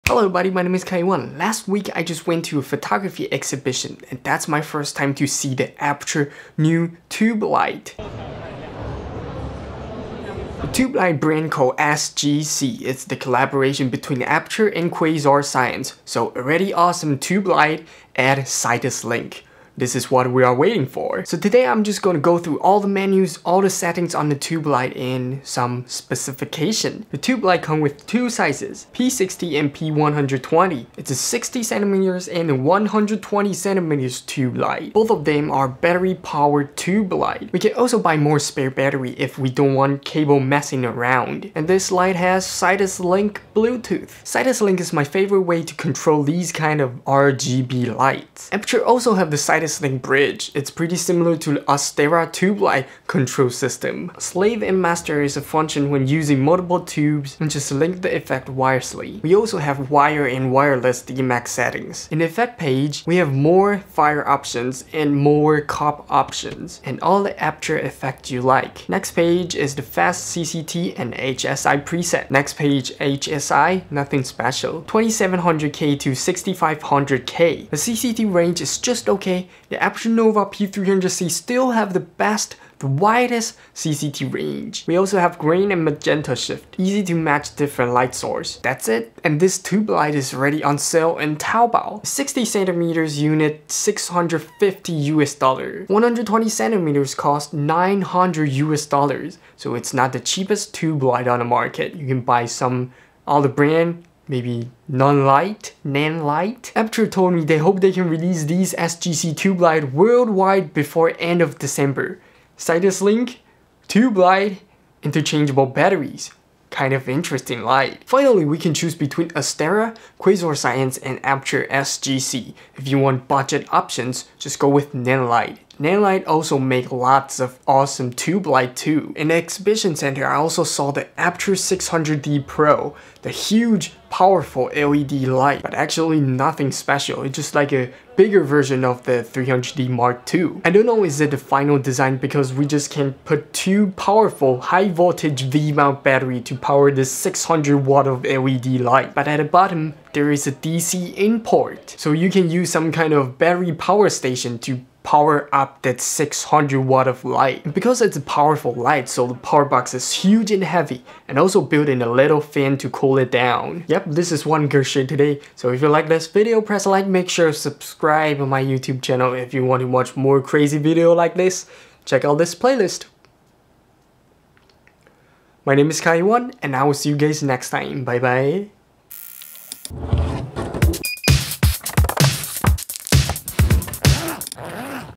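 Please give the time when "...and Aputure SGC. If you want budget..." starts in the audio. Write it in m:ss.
2:00.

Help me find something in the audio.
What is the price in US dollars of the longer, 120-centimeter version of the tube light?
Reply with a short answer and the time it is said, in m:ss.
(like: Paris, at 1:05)
900 US dollars, at 1:37.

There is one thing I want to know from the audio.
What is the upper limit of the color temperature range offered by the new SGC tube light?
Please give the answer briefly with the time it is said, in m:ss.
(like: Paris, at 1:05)
6500K, at 1:16.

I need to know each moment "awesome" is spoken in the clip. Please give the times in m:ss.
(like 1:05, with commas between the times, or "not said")
0:16, 2:07.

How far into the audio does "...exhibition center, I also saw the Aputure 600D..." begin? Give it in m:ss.
2:09.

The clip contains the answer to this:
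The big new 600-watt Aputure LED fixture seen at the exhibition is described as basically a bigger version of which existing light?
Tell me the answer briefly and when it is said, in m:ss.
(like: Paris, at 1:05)
300D Mark II, at 2:19.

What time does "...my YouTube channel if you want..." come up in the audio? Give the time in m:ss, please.
2:48.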